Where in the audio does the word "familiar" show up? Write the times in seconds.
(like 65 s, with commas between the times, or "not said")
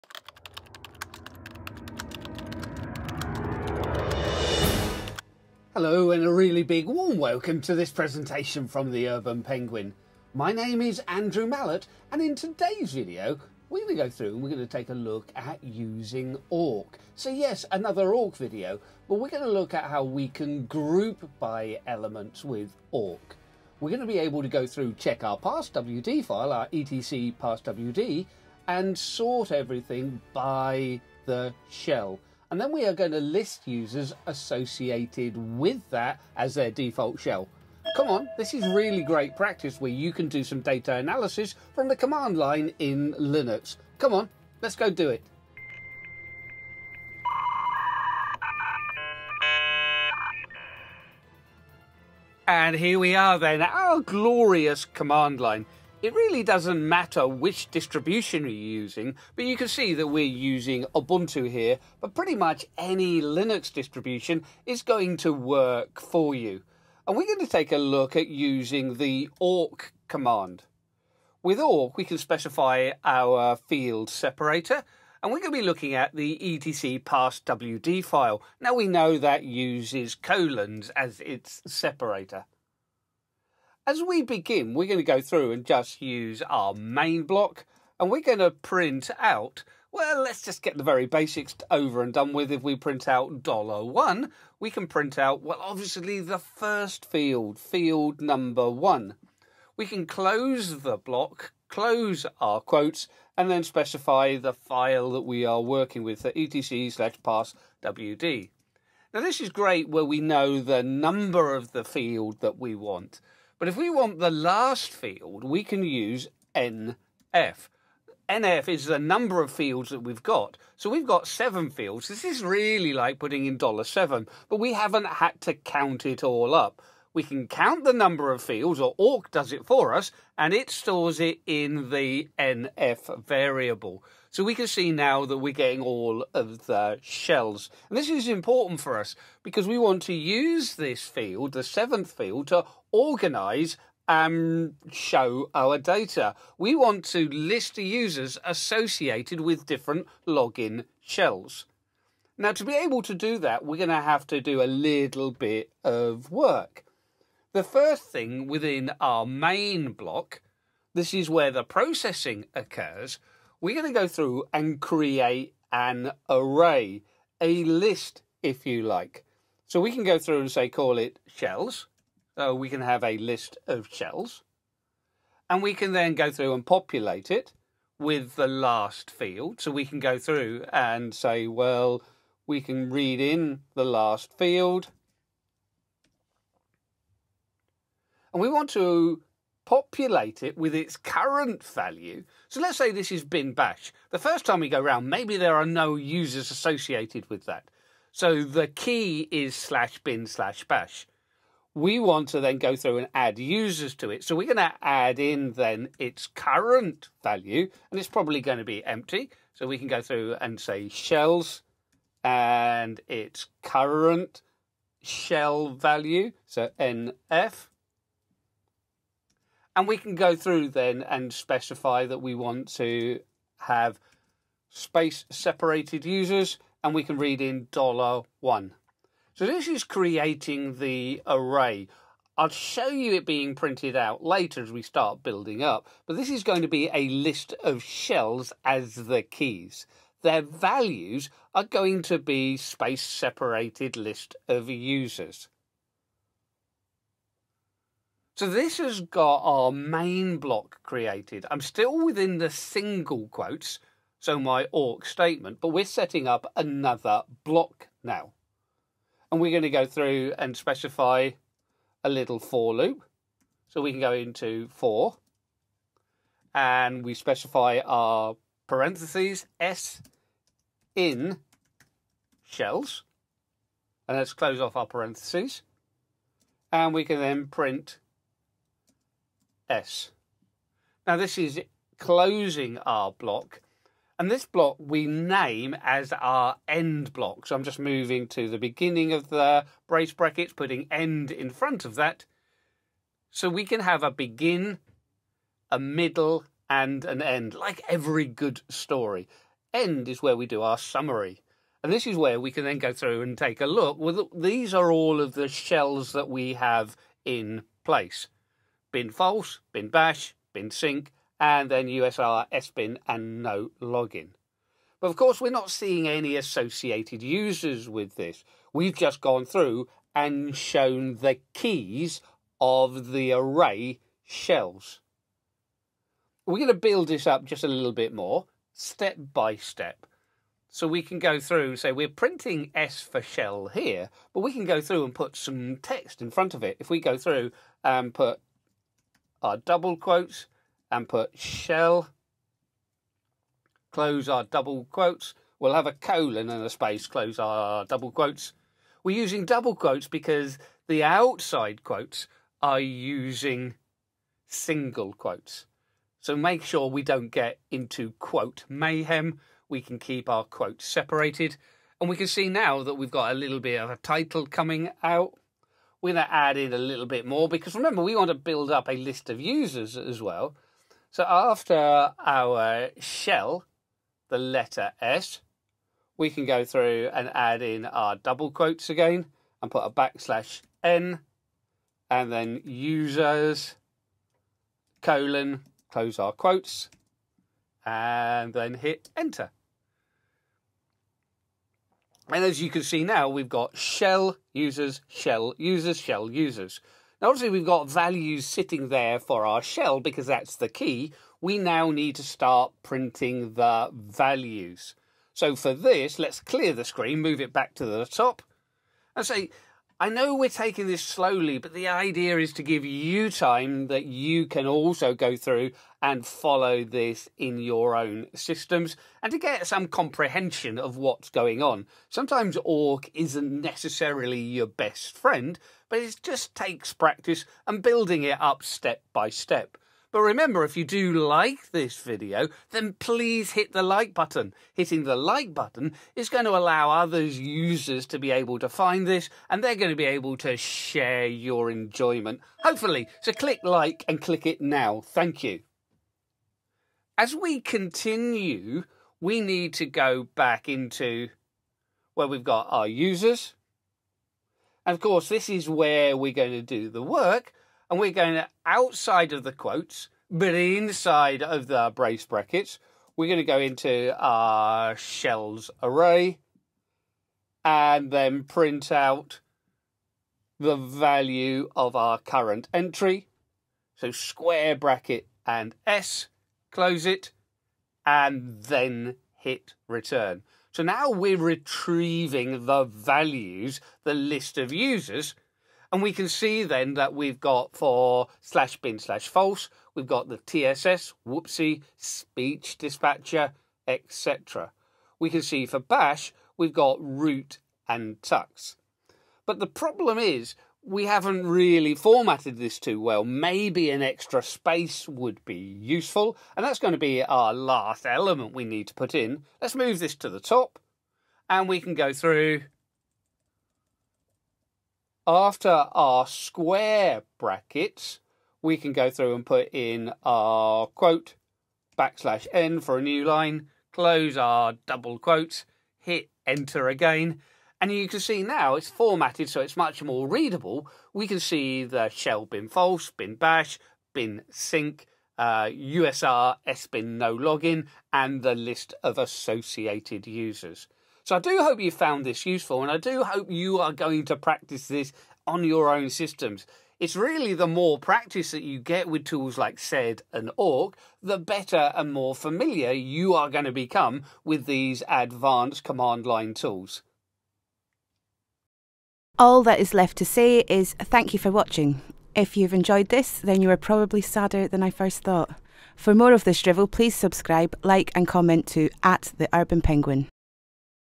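552 s.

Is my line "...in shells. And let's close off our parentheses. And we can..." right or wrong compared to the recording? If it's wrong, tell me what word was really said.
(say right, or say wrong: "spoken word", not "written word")
right.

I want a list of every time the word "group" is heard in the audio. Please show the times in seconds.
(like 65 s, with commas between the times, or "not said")
20 s.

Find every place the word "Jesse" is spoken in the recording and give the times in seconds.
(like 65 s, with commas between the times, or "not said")
not said.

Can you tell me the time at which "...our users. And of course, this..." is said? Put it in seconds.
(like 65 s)
452 s.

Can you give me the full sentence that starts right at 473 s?
So square bracket and S, close it, and then hit return.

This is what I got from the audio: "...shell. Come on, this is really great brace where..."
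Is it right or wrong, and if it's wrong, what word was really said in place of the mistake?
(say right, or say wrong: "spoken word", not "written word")
wrong: "practice", not "brace".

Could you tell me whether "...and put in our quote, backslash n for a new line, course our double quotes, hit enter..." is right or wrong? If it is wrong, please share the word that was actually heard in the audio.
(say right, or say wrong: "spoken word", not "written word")
wrong: "close", not "course".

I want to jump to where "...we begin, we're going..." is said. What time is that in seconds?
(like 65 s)
84 s.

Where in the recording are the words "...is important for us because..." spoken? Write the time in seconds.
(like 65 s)
138 s.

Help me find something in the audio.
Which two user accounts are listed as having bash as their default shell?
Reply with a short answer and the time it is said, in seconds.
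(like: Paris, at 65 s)
root and tux, at 497 s.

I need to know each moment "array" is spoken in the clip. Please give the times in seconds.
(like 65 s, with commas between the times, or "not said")
166 s, 231 s, 323 s, 465 s.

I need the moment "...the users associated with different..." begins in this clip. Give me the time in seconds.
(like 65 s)
147 s.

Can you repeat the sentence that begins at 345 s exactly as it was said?
We'll have a colon and a space, close our double quotes.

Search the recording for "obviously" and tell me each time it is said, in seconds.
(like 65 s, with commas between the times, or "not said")
95 s, 397 s.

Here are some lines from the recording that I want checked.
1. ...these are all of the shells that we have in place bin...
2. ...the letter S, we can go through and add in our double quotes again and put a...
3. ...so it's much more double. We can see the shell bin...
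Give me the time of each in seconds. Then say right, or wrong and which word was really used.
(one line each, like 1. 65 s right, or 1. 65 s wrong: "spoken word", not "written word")
1. 304 s right
2. 374 s right
3. 529 s wrong: "readable", not "double".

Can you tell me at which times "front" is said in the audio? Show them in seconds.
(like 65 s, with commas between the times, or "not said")
291 s, 336 s.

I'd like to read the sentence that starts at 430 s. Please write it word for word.
But remember, if you do like this video, then please hit the like button.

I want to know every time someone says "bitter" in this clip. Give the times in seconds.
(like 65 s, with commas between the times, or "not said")
not said.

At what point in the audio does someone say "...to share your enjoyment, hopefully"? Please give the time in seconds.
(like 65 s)
440 s.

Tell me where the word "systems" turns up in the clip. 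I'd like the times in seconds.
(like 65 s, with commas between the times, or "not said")
418 s, 546 s.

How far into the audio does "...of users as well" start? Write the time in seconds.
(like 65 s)
369 s.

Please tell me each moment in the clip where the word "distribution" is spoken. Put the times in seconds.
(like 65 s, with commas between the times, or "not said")
57 s, 63 s.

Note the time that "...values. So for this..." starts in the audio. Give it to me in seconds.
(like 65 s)
403 s.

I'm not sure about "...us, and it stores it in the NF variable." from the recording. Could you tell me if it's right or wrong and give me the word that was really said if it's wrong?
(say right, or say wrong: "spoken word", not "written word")
right.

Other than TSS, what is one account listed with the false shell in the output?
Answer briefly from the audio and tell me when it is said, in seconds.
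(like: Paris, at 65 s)
whoopsie, at 491 s.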